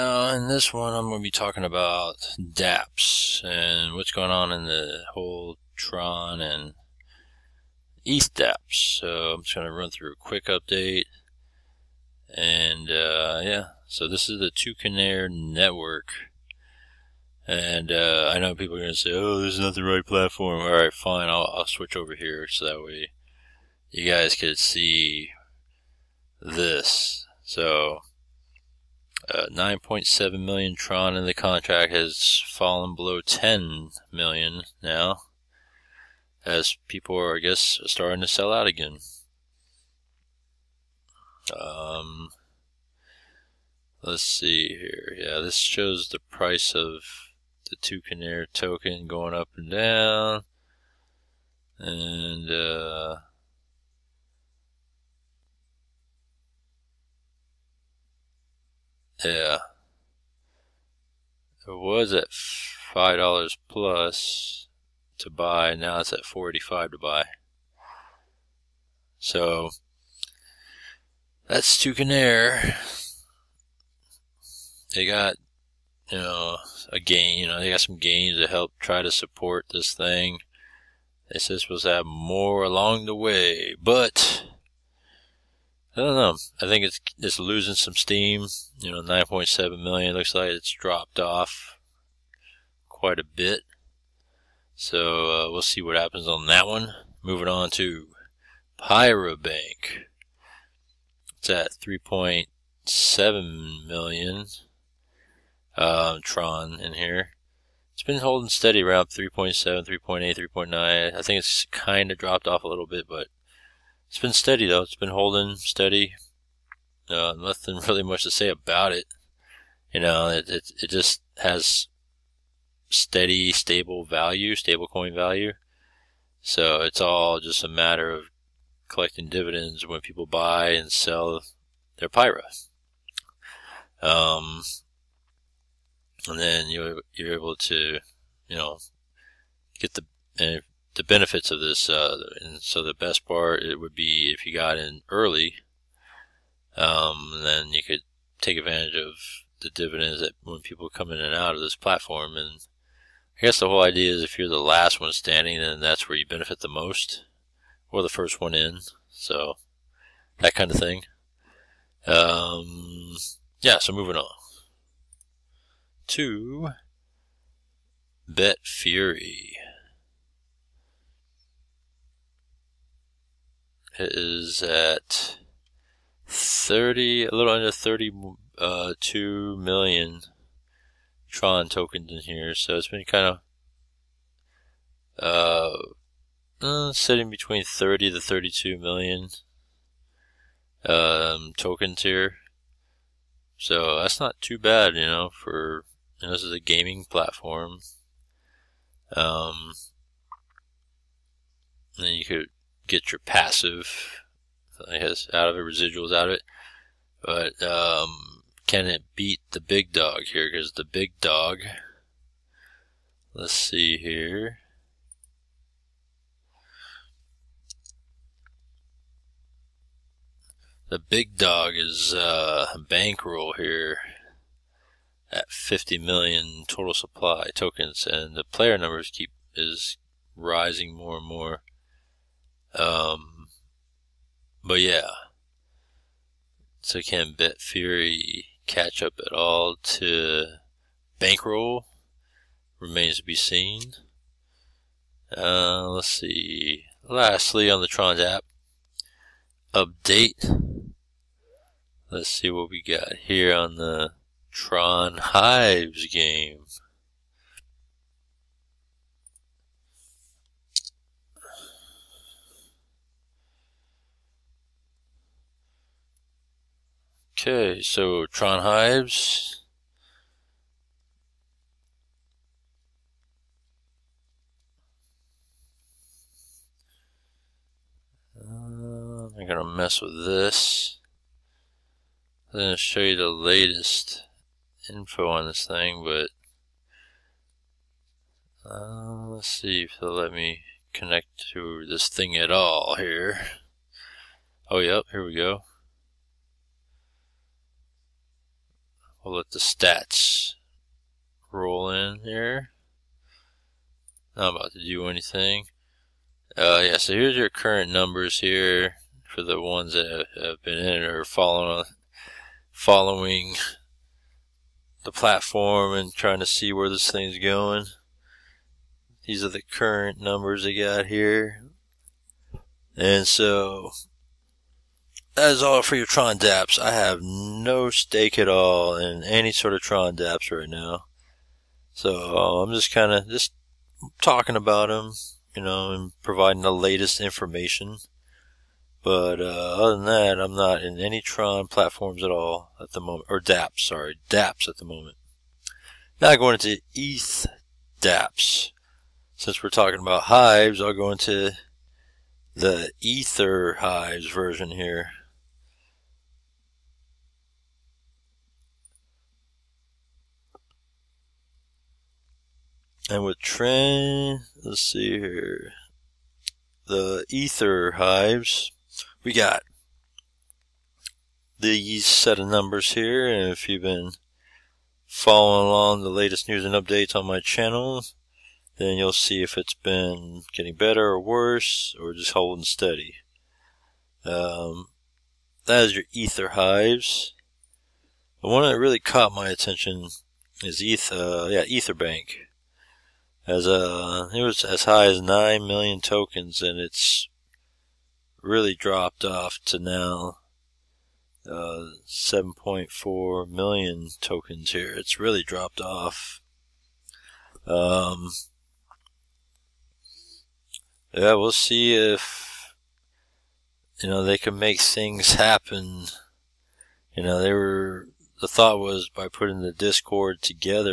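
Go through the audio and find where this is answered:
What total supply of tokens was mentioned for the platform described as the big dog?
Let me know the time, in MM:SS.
03:45.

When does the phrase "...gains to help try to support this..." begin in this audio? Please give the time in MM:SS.
01:17.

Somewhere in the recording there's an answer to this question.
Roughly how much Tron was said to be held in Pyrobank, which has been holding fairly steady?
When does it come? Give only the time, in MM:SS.
01:41.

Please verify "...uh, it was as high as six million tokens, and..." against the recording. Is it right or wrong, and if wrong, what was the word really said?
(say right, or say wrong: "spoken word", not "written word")
wrong: "nine", not "six".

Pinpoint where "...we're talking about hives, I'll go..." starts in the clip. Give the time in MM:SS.
05:49.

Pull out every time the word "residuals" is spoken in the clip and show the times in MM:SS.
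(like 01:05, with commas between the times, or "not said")
03:25.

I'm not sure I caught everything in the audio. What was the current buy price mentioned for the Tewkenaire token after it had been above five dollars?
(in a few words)
$4.85.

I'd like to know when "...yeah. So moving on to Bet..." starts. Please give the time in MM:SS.
02:43.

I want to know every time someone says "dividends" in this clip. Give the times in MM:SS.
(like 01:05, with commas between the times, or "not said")
02:09, 02:29.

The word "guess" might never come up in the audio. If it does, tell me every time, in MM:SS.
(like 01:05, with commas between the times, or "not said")
00:37, 02:33, 03:24.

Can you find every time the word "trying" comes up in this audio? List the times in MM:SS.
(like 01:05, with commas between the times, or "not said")
05:16.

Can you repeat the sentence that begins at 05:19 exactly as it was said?
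These are the current numbers they got here.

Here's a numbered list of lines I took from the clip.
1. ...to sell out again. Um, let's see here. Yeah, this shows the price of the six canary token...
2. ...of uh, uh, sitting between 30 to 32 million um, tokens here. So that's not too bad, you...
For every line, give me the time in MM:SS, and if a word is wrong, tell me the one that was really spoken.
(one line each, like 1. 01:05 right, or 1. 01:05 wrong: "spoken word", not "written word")
1. 00:38 wrong: "two", not "six"
2. 03:05 right.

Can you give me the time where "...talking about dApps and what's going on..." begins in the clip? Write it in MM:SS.
00:01.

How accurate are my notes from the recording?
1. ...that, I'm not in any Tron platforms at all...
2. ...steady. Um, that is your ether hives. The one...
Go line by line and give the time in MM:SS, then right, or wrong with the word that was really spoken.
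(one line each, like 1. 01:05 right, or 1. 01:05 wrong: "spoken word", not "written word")
1. 05:40 right
2. 06:22 right.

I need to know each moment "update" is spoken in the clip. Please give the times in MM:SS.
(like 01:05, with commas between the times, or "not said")
00:10, 04:09, 06:16.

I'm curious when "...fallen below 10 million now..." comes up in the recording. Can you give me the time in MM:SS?
00:32.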